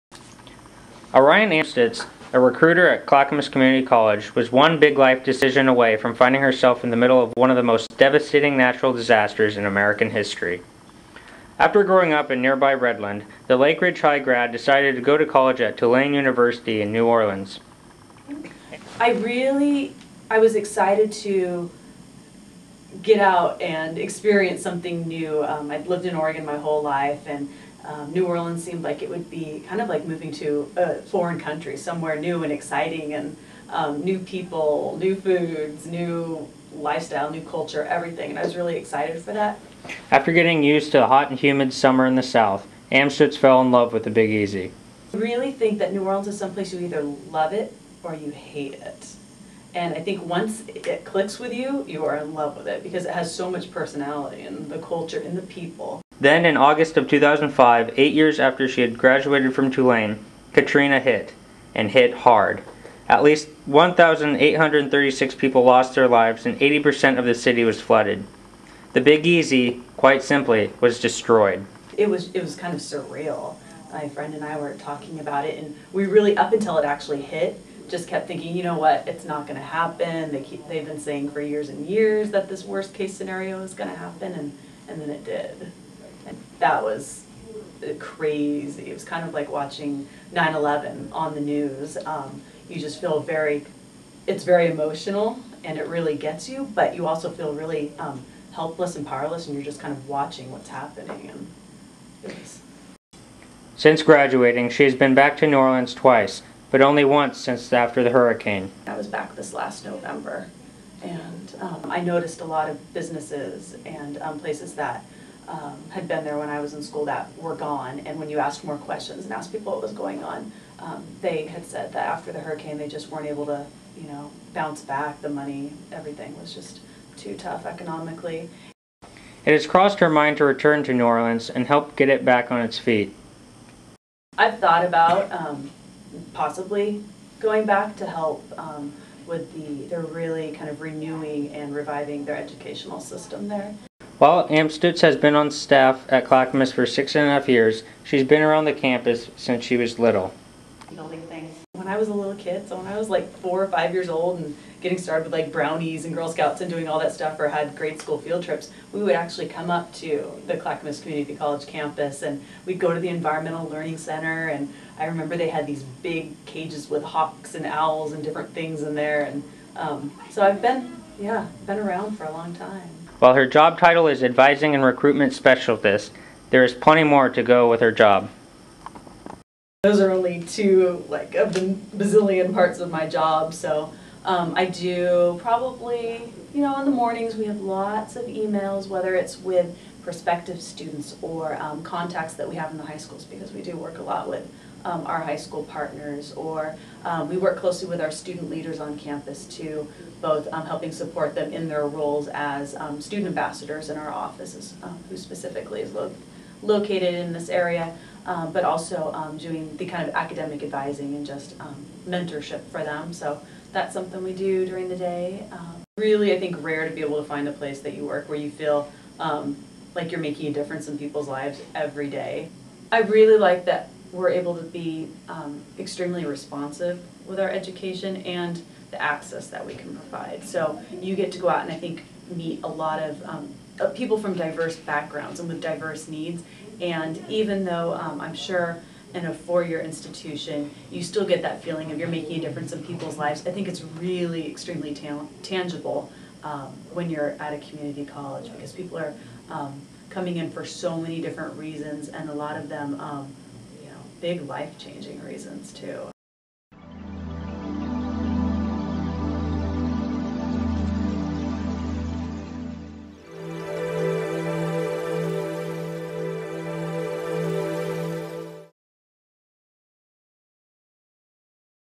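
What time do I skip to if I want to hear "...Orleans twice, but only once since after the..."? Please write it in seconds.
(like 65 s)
105 s.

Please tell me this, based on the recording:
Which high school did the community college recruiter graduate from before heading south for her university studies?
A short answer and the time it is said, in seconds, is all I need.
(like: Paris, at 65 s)
Lake Ridge High, at 13 s.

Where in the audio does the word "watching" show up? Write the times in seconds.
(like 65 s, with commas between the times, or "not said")
89 s, 100 s.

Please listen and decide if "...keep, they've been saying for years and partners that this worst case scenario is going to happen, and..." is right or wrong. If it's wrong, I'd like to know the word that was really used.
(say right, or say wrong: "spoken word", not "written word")
wrong: "years", not "partners".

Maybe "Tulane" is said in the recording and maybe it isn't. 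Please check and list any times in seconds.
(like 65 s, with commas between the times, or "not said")
15 s, 59 s.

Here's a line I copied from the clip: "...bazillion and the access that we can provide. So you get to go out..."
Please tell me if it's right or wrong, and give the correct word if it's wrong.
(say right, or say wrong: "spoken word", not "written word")
wrong: "education", not "bazillion".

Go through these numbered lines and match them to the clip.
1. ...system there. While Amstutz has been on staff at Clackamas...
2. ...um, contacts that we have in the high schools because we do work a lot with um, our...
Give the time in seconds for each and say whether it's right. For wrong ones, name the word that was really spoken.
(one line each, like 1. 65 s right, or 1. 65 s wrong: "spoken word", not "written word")
1. 143 s right
2. 191 s right.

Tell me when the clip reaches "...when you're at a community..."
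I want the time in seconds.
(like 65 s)
246 s.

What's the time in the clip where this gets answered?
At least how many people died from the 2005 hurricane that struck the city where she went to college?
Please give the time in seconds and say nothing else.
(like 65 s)
63 s.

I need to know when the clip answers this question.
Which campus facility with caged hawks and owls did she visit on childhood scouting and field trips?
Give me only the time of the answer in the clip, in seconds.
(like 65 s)
163 s.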